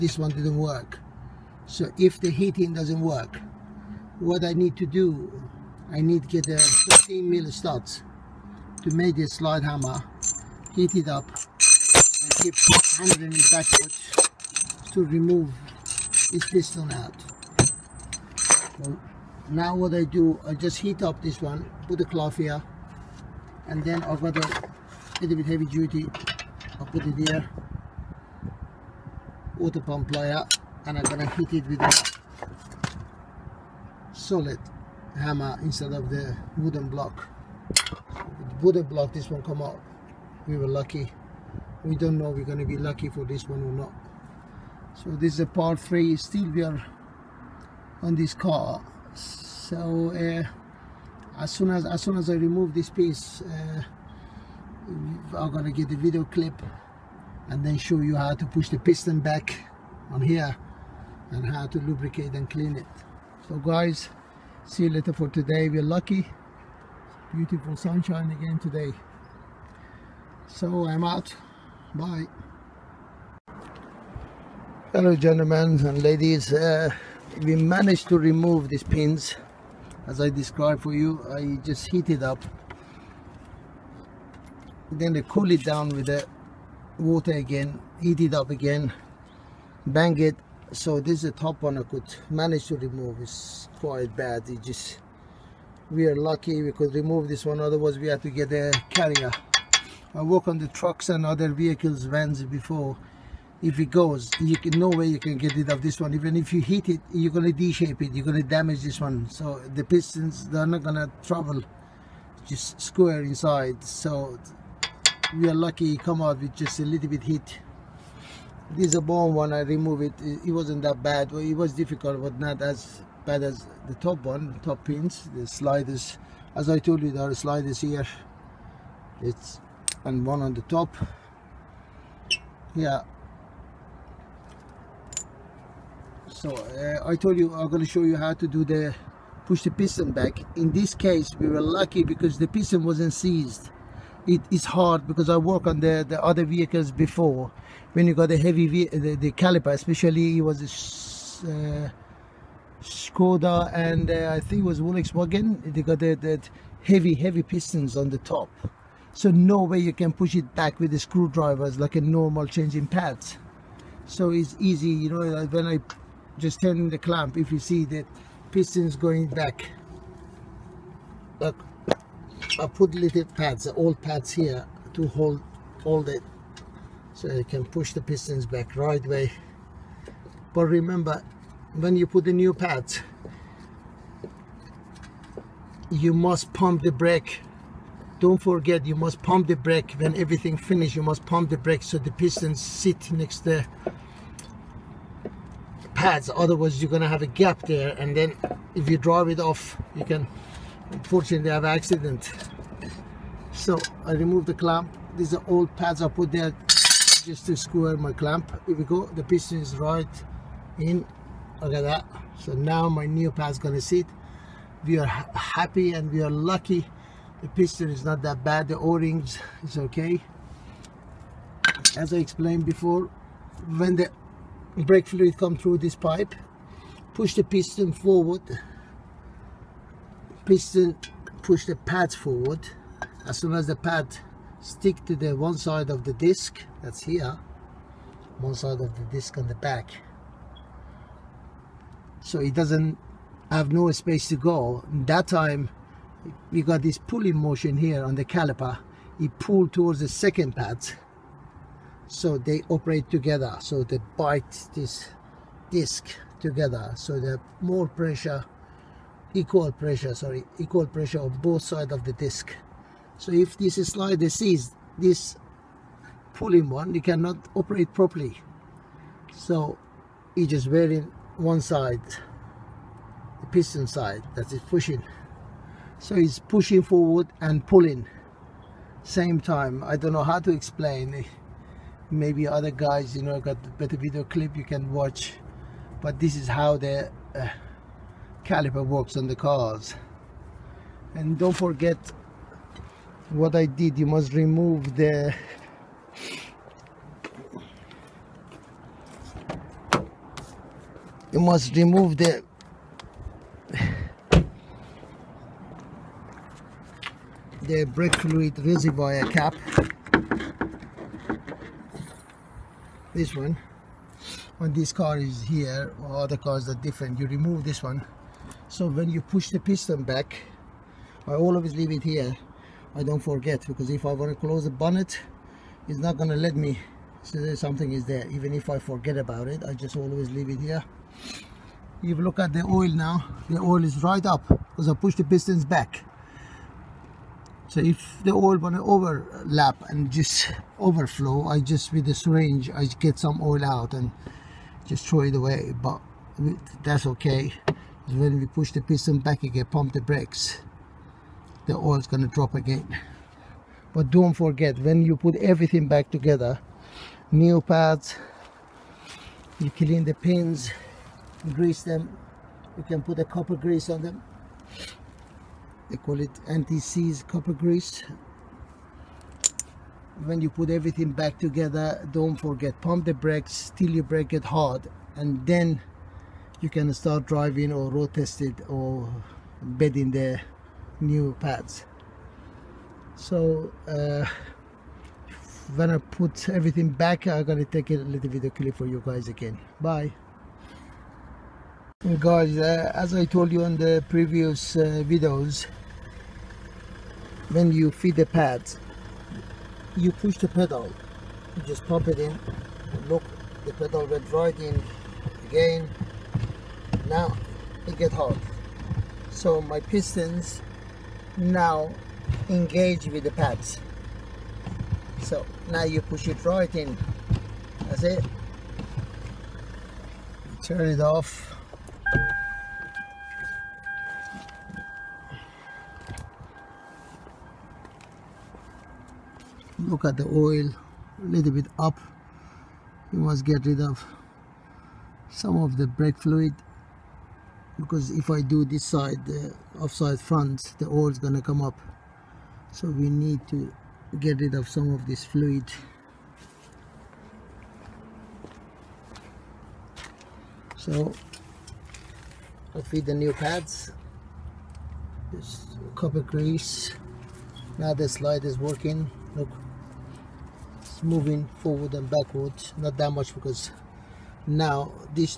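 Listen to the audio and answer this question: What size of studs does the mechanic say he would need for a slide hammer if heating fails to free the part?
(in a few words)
13 mil.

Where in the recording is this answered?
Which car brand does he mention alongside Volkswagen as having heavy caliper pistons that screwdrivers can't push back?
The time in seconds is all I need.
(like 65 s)
152 s.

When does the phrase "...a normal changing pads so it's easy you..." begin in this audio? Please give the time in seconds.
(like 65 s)
161 s.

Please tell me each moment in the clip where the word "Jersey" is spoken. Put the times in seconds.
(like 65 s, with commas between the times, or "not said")
not said.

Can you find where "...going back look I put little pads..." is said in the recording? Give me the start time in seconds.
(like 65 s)
168 s.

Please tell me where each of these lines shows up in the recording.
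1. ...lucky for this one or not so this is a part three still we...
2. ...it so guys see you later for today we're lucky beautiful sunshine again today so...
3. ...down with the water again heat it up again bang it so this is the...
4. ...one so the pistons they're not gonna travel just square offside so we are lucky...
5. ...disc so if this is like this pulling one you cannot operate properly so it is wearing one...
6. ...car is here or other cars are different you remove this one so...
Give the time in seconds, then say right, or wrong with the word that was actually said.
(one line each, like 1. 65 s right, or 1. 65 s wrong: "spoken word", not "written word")
1. 42 s right
2. 62 s right
3. 85 s right
4. 108 s wrong: "inside", not "offside"
5. 262 s right
6. 314 s right.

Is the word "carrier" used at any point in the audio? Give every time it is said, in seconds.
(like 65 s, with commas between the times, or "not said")
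98 s.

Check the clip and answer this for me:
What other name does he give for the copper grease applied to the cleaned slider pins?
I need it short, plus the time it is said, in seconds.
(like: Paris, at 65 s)
anti-seize, at 366 s.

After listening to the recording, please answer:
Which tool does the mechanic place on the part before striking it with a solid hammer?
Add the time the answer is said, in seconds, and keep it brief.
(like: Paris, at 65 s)
water pump plier, at 29 s.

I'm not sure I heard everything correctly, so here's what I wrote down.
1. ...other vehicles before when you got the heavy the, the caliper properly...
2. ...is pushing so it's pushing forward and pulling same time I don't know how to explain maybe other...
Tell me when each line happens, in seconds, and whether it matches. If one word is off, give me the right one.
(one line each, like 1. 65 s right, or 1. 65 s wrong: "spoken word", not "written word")
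1. 146 s wrong: "especially", not "properly"
2. 274 s right.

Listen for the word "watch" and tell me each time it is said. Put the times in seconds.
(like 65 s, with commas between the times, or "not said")
284 s.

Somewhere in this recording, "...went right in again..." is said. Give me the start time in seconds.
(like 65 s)
404 s.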